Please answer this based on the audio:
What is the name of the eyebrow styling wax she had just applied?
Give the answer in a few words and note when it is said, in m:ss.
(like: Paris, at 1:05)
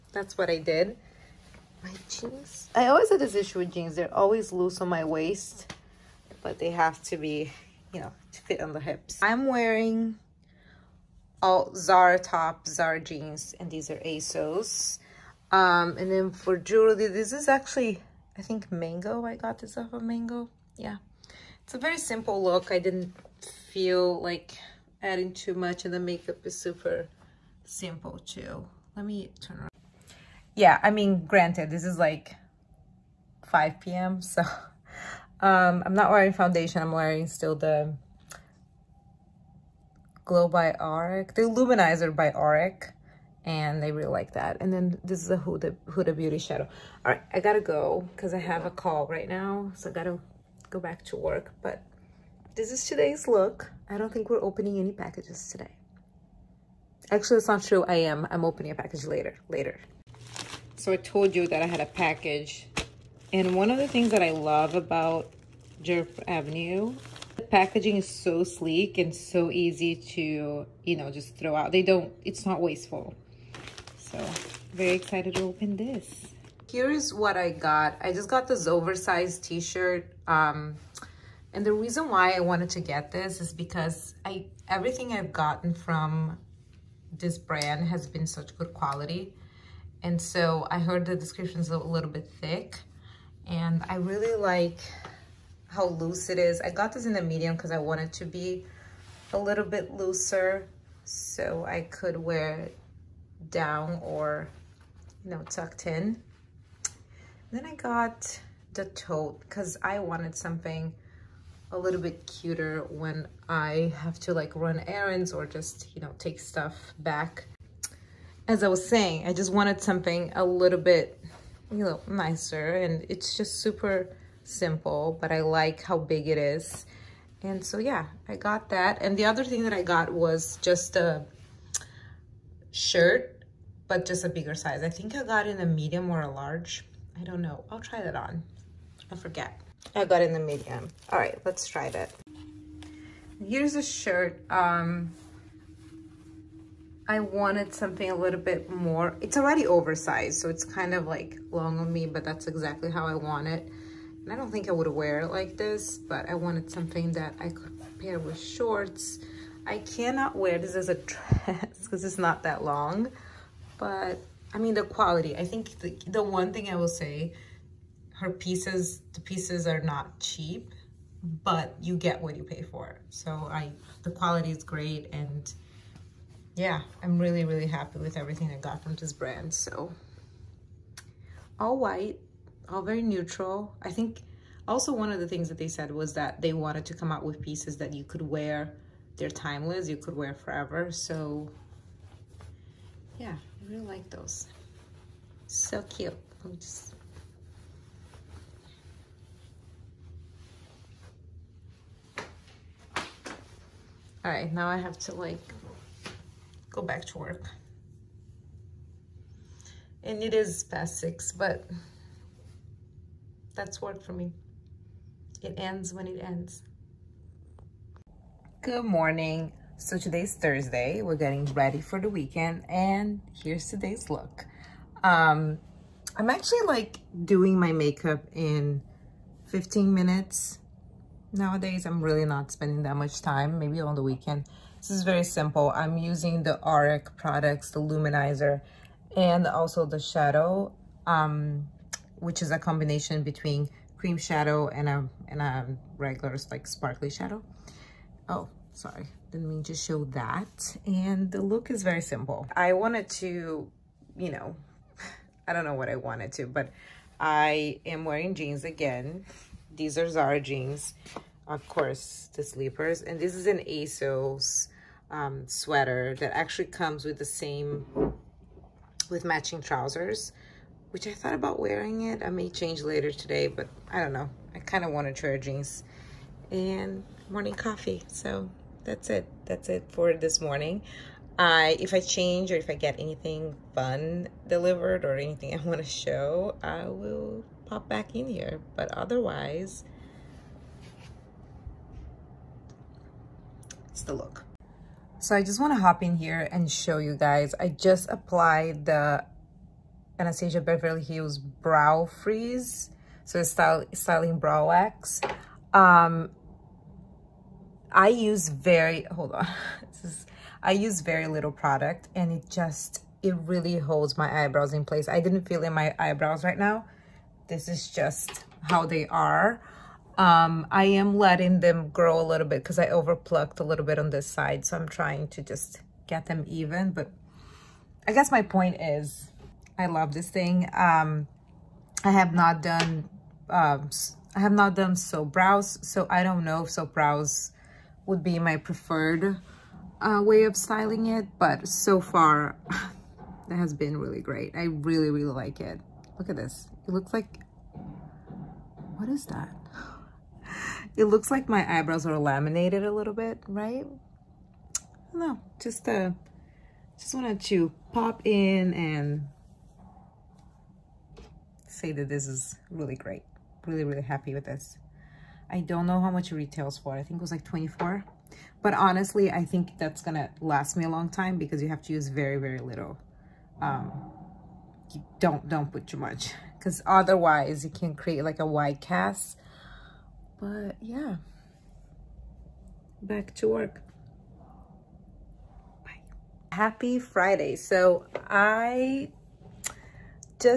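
Brow Freeze, at 5:01.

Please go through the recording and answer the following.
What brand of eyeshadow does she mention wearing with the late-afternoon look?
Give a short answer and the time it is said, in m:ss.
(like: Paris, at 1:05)
Huda Beauty, at 0:45.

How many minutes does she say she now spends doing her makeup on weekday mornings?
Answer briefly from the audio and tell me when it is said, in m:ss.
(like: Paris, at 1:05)
15, at 3:49.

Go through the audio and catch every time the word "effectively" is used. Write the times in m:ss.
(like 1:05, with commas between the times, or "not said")
not said.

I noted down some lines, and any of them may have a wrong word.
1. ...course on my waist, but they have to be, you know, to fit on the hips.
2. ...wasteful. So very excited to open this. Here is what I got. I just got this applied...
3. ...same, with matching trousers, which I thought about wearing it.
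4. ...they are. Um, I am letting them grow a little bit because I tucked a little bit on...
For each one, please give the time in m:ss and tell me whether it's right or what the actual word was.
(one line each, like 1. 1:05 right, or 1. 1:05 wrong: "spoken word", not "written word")
1. 0:04 wrong: "loose", not "course"
2. 1:12 wrong: "oversized", not "applied"
3. 4:27 right
4. 5:18 wrong: "overplucked", not "tucked".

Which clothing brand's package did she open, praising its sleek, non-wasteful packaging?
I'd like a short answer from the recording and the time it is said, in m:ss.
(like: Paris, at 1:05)
Djerf Avenue, at 1:05.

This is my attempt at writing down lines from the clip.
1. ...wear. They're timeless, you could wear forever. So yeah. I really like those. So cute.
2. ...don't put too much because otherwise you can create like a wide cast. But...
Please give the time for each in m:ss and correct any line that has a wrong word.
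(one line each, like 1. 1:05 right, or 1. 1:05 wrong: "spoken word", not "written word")
1. 3:08 right
2. 6:15 right.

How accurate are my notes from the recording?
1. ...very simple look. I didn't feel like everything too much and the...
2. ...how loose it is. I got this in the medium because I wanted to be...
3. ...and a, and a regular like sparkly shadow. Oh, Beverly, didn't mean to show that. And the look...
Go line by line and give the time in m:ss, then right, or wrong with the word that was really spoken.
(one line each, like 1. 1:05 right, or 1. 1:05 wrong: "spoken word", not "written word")
1. 0:21 wrong: "adding", not "everything"
2. 1:35 right
3. 4:04 wrong: "Sorry", not "Beverly".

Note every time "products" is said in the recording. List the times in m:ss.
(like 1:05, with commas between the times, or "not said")
3:57, 5:11.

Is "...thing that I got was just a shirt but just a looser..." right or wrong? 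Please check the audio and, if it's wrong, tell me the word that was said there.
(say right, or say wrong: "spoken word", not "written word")
wrong: "bigger", not "looser".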